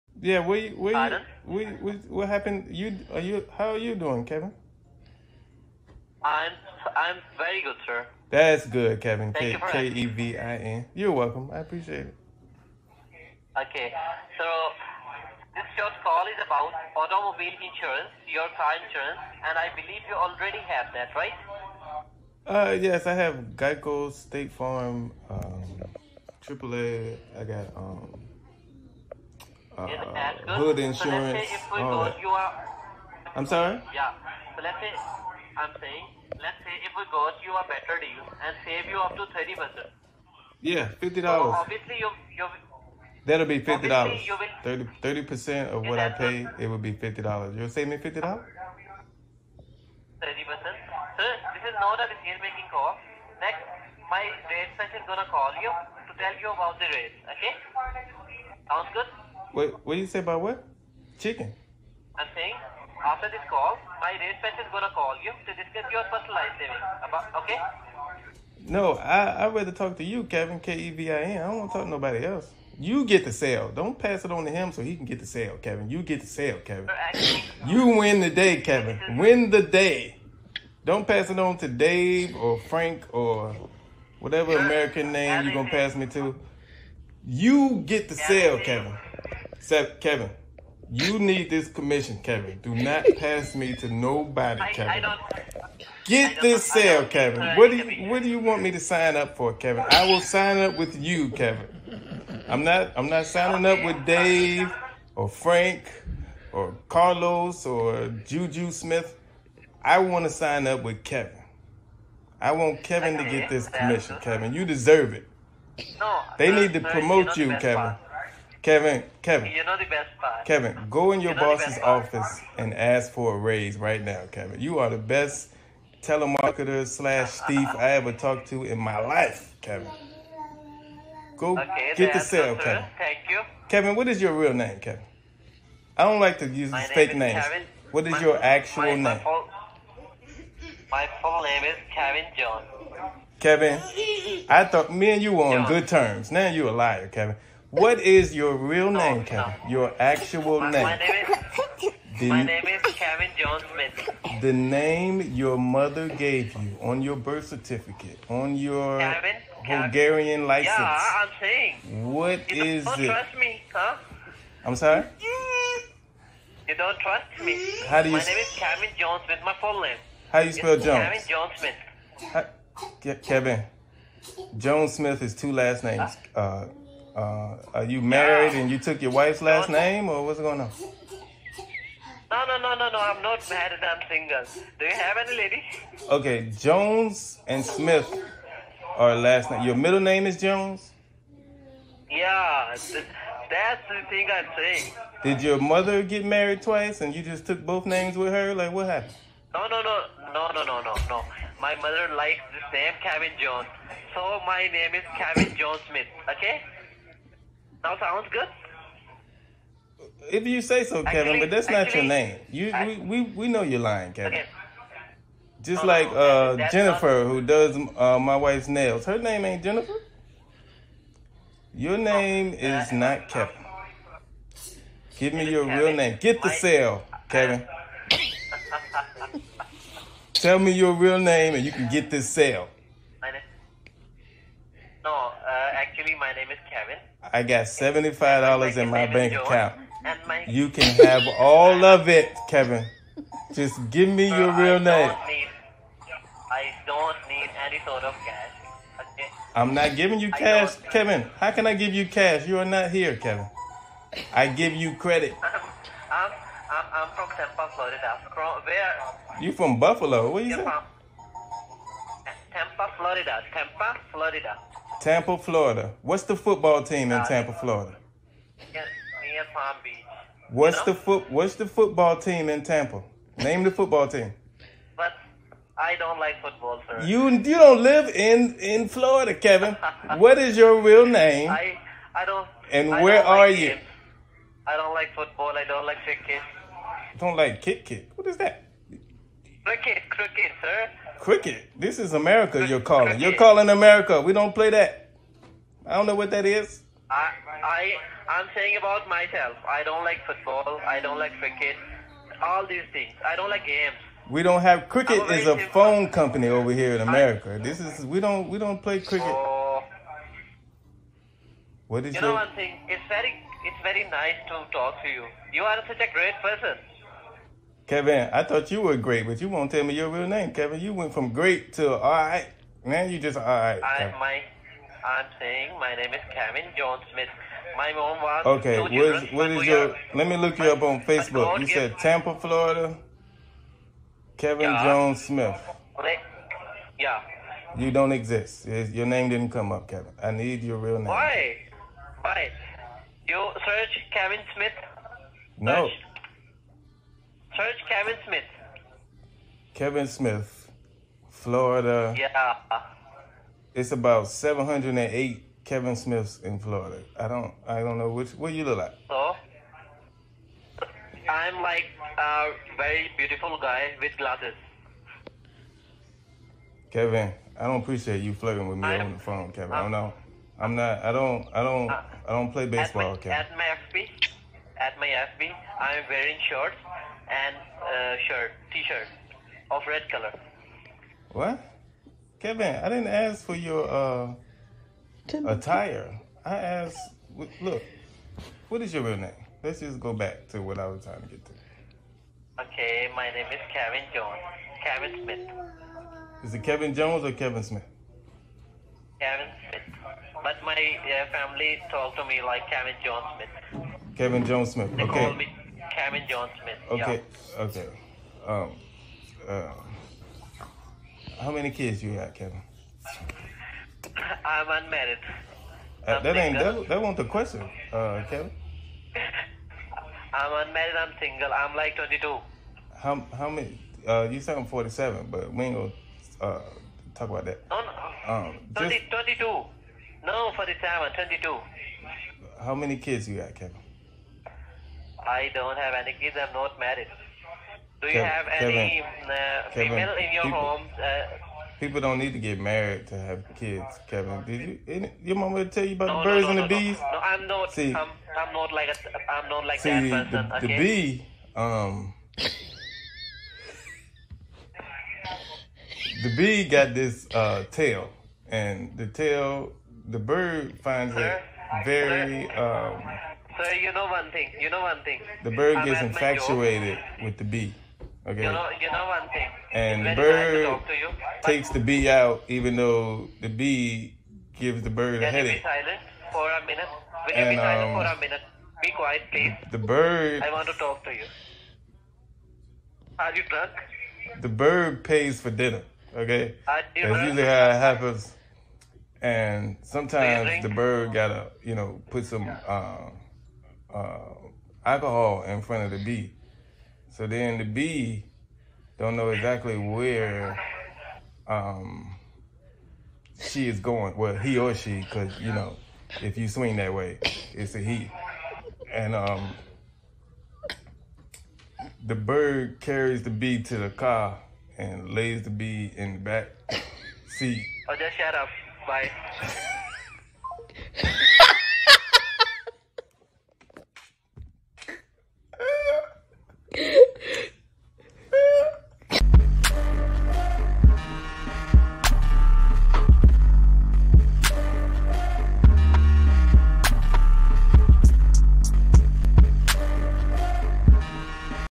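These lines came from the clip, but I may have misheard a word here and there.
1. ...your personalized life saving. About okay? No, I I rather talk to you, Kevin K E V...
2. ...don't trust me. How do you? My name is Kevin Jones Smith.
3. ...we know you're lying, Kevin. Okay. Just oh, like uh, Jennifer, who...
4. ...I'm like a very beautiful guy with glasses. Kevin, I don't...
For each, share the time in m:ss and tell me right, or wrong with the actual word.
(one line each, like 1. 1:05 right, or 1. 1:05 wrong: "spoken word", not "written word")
1. 1:05 right
2. 2:46 right
3. 3:33 right
4. 6:01 right.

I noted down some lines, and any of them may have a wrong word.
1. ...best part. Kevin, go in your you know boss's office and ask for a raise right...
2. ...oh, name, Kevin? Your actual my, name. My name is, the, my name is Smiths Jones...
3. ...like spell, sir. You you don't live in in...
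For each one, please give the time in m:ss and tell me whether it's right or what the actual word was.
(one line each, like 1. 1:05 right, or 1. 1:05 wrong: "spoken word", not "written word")
1. 1:59 right
2. 2:28 wrong: "Kevin", not "Smiths"
3. 4:36 wrong: "football", not "spell".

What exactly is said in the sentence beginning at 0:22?
Uh, yes, I have Geico, State Farm, um, AAA.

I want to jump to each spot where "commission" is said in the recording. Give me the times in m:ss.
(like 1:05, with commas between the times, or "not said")
1:31, 1:53.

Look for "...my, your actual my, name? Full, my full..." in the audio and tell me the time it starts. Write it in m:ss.
2:18.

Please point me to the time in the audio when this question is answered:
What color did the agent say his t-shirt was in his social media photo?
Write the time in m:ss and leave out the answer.
6:19.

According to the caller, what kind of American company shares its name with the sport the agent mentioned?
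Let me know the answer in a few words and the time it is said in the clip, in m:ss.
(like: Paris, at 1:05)
A phone company, at 5:05.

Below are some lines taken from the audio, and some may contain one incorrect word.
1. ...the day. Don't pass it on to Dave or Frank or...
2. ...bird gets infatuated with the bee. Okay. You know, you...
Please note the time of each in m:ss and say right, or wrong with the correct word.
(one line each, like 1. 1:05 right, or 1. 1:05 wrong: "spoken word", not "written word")
1. 1:19 right
2. 7:45 right.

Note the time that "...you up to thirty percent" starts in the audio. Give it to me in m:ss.
0:38.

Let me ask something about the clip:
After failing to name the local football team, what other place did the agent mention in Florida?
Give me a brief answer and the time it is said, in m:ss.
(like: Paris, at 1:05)
Palm Beach, at 4:29.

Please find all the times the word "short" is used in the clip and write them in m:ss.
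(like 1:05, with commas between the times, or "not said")
0:15, 6:16.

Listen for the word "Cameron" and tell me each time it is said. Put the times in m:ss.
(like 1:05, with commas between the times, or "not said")
6:45.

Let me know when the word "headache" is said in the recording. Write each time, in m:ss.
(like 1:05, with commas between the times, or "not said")
7:55.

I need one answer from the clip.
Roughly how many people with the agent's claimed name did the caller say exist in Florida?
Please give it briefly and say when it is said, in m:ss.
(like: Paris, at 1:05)
708, at 5:54.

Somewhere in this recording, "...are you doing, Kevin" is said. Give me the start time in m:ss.
0:03.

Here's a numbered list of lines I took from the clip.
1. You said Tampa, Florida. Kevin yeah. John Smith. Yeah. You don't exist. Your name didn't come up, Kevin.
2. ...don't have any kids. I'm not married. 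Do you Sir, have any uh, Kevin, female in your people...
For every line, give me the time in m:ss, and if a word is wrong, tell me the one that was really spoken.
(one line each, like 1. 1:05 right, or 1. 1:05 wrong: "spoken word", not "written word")
1. 5:31 right
2. 7:15 wrong: "Kevin", not "Sir".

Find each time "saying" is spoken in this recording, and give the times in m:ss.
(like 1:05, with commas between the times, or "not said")
0:35, 1:02, 2:41, 3:14, 4:58, 5:25.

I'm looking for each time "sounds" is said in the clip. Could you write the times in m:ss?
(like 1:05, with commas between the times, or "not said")
0:58, 3:27.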